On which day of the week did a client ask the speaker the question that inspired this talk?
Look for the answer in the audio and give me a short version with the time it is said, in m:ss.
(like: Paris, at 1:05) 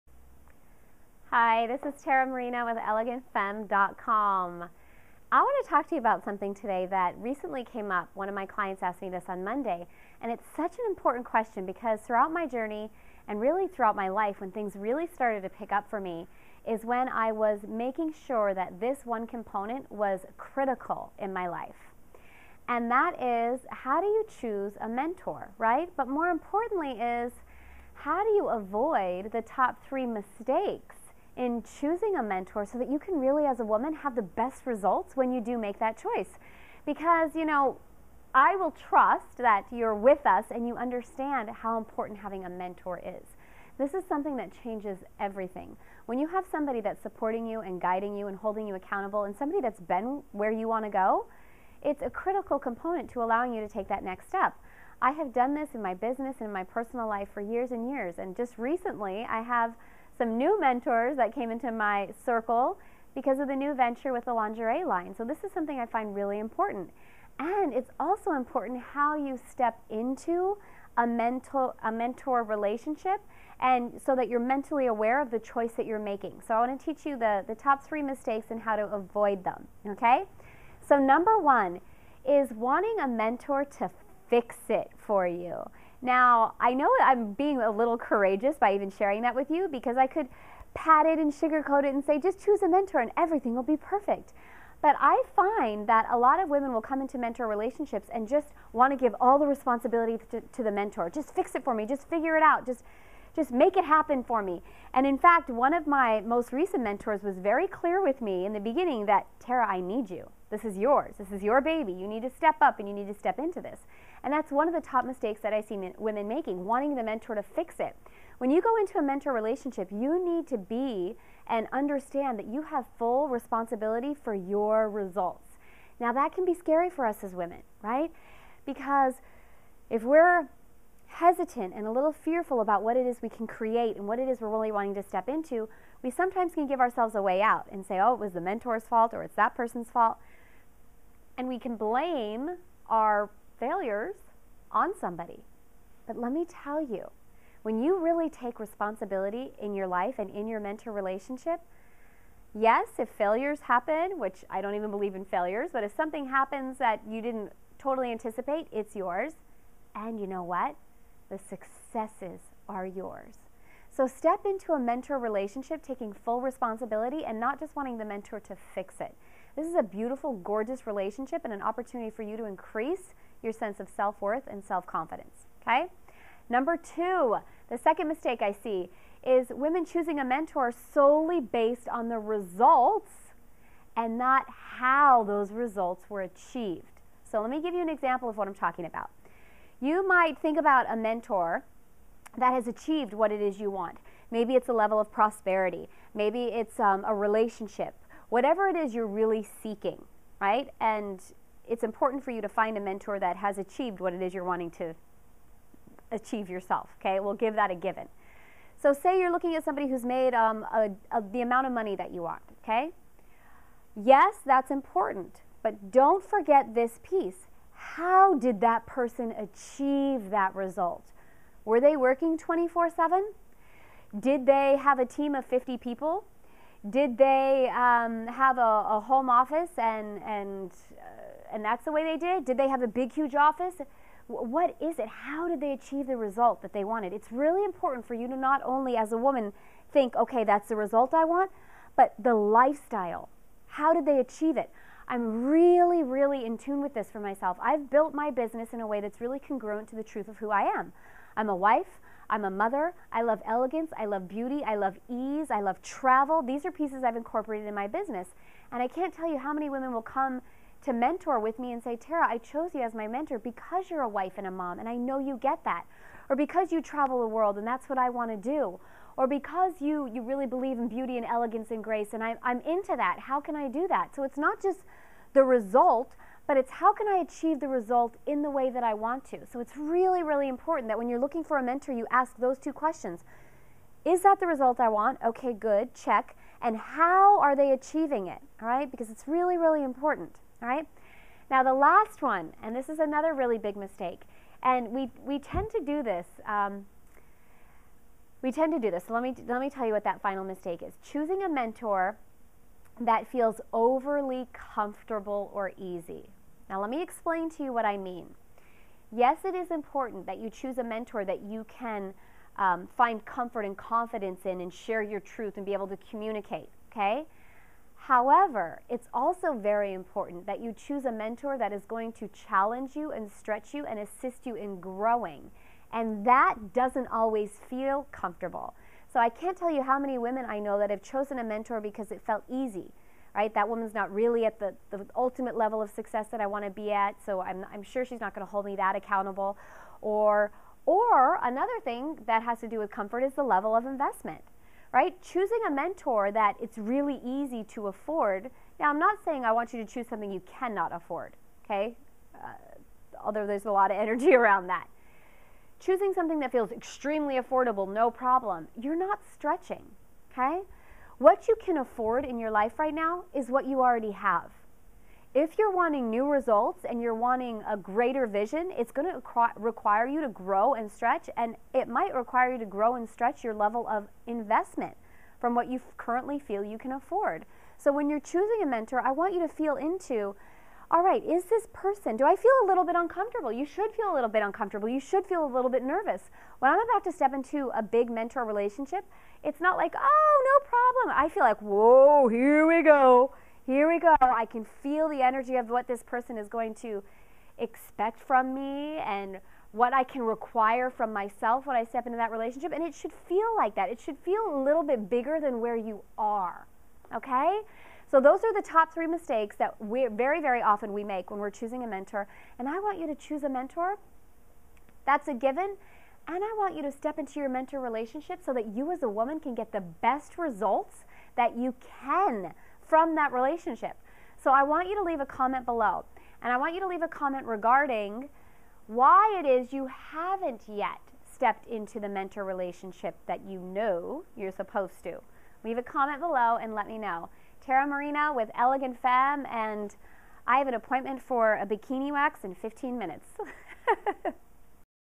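Monday, at 0:09.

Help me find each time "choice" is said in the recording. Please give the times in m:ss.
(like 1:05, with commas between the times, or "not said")
0:36, 1:15.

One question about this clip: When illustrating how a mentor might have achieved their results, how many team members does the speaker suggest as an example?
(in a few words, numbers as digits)
50.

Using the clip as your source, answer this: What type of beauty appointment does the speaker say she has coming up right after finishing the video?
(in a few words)
Bikini wax.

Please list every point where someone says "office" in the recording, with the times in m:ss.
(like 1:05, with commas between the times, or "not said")
3:49, 3:53.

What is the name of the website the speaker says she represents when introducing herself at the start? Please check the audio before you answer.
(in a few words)
ElegantFemme.com.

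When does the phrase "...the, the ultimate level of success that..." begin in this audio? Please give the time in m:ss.
5:34.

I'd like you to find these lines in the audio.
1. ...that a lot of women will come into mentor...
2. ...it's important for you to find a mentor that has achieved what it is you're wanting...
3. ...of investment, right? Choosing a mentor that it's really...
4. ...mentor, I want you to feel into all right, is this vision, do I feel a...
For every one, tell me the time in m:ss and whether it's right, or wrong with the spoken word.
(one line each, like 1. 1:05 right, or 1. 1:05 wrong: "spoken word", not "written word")
1. 1:35 right
2. 3:21 right
3. 5:43 right
4. 6:18 wrong: "person", not "vision".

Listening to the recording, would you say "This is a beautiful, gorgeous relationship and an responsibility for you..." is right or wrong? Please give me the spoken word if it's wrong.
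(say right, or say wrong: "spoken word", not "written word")
wrong: "opportunity", not "responsibility".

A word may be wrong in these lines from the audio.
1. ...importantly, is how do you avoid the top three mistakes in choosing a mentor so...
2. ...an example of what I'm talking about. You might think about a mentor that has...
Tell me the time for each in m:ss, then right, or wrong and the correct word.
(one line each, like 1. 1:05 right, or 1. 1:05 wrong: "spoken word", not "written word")
1. 0:26 right
2. 3:07 right.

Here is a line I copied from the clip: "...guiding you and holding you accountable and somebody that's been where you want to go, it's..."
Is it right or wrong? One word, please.
right.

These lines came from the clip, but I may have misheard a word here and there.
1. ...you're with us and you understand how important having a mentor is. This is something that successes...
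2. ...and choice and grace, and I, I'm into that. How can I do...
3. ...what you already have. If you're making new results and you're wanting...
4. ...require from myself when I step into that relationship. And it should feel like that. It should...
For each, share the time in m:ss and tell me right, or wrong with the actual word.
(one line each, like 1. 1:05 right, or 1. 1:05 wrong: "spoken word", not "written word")
1. 0:39 wrong: "changes", not "successes"
2. 4:31 wrong: "elegance", not "choice"
3. 6:03 wrong: "wanting", not "making"
4. 6:40 right.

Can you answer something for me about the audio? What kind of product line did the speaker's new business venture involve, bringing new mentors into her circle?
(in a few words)
Lingerie.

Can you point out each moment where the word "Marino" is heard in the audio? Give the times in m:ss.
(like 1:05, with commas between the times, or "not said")
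0:02, 7:17.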